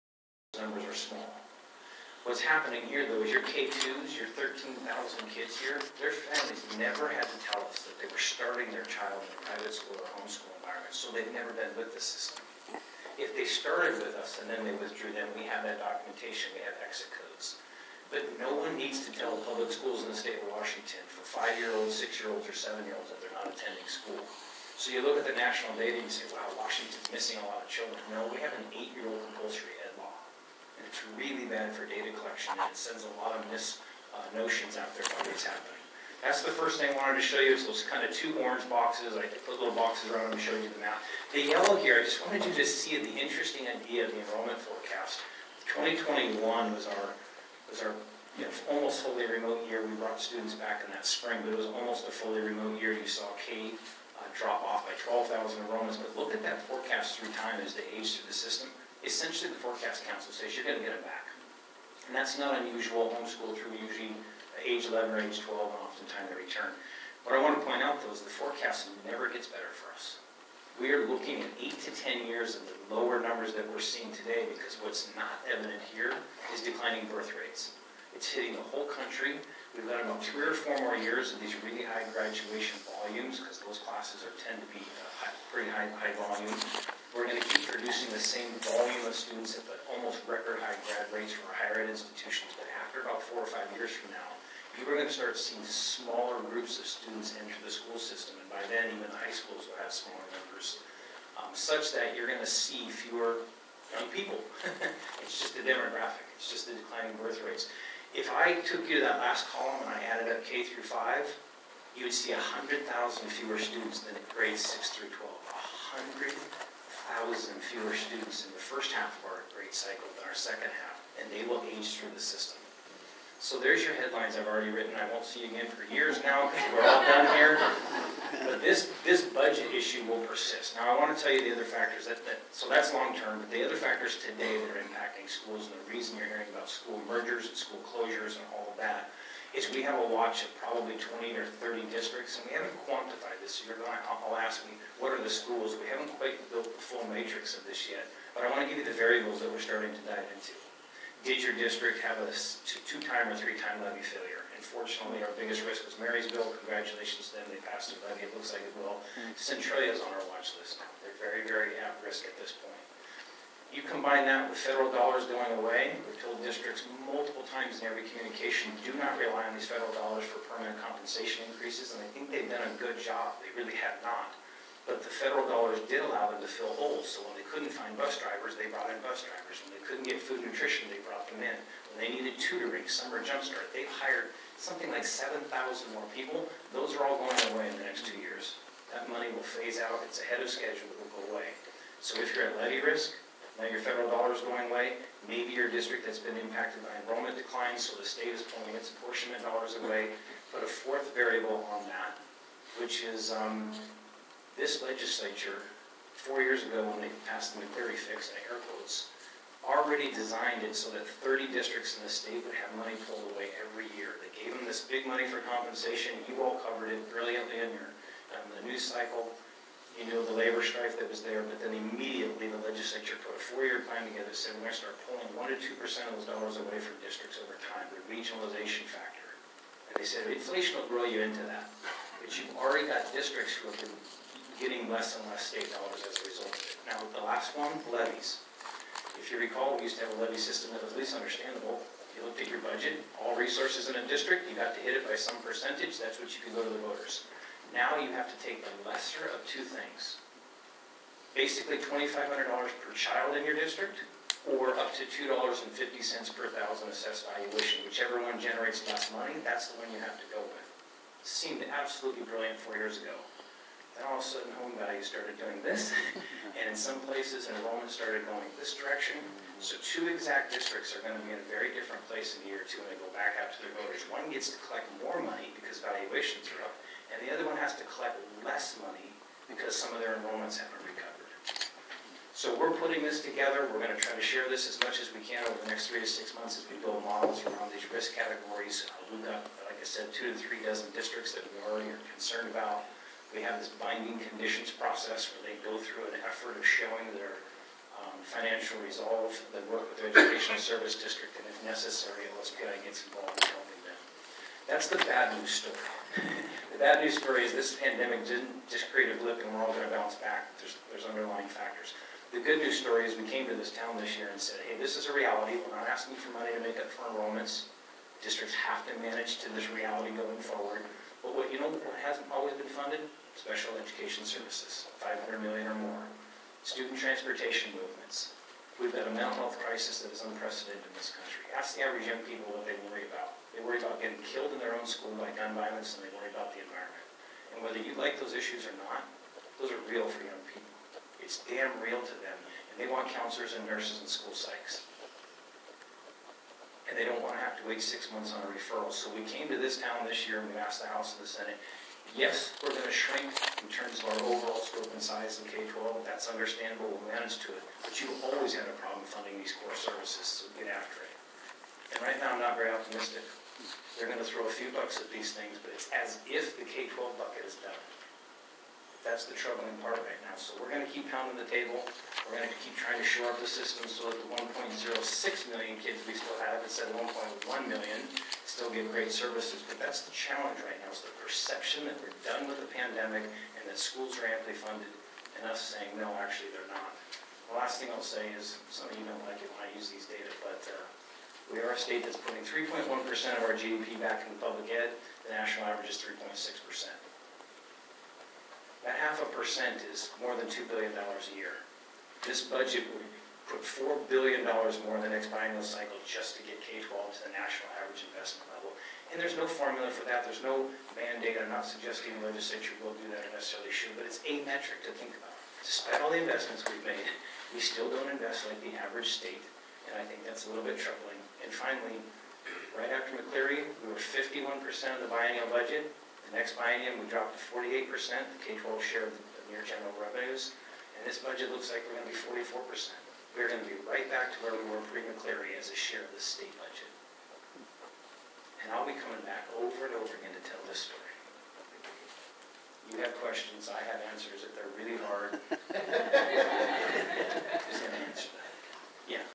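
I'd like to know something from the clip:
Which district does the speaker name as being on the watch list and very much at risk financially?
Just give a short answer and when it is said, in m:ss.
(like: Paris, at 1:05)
Centralia, at 2:39.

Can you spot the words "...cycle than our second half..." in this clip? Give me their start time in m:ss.
1:59.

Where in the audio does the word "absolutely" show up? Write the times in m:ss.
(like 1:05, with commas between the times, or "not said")
4:21.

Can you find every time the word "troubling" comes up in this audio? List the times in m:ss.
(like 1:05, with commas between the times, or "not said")
6:09, 7:00.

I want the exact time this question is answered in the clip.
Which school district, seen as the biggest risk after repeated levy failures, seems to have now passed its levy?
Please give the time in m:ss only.
2:35.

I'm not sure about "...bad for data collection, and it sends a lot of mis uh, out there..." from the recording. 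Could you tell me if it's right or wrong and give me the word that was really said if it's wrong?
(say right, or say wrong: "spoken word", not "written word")
right.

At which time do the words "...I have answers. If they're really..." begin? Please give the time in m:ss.
7:23.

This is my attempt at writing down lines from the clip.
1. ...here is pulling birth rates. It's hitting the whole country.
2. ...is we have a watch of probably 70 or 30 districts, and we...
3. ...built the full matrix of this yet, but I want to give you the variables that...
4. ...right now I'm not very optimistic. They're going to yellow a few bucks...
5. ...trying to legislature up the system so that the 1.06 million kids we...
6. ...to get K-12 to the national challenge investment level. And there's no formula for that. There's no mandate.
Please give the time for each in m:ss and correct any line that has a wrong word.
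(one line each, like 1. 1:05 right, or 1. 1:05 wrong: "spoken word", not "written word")
1. 1:15 wrong: "declining", not "pulling"
2. 2:19 wrong: "20", not "70"
3. 2:26 right
4. 6:02 wrong: "throw", not "yellow"
5. 6:12 wrong: "shore", not "legislature"
6. 6:46 wrong: "average", not "challenge".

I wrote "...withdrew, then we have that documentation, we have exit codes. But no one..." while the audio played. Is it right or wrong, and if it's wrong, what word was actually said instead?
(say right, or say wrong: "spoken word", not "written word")
right.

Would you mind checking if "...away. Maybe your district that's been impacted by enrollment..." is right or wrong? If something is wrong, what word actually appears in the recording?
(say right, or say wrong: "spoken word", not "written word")
right.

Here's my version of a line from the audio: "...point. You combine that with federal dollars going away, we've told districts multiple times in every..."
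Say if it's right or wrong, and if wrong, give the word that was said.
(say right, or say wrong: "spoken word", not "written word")
right.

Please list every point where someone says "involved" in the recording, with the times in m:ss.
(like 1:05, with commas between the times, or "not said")
5:03.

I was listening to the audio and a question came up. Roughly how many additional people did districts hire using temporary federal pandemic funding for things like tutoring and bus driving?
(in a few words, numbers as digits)
7,000.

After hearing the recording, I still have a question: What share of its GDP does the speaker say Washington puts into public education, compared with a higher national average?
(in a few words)
3.1%.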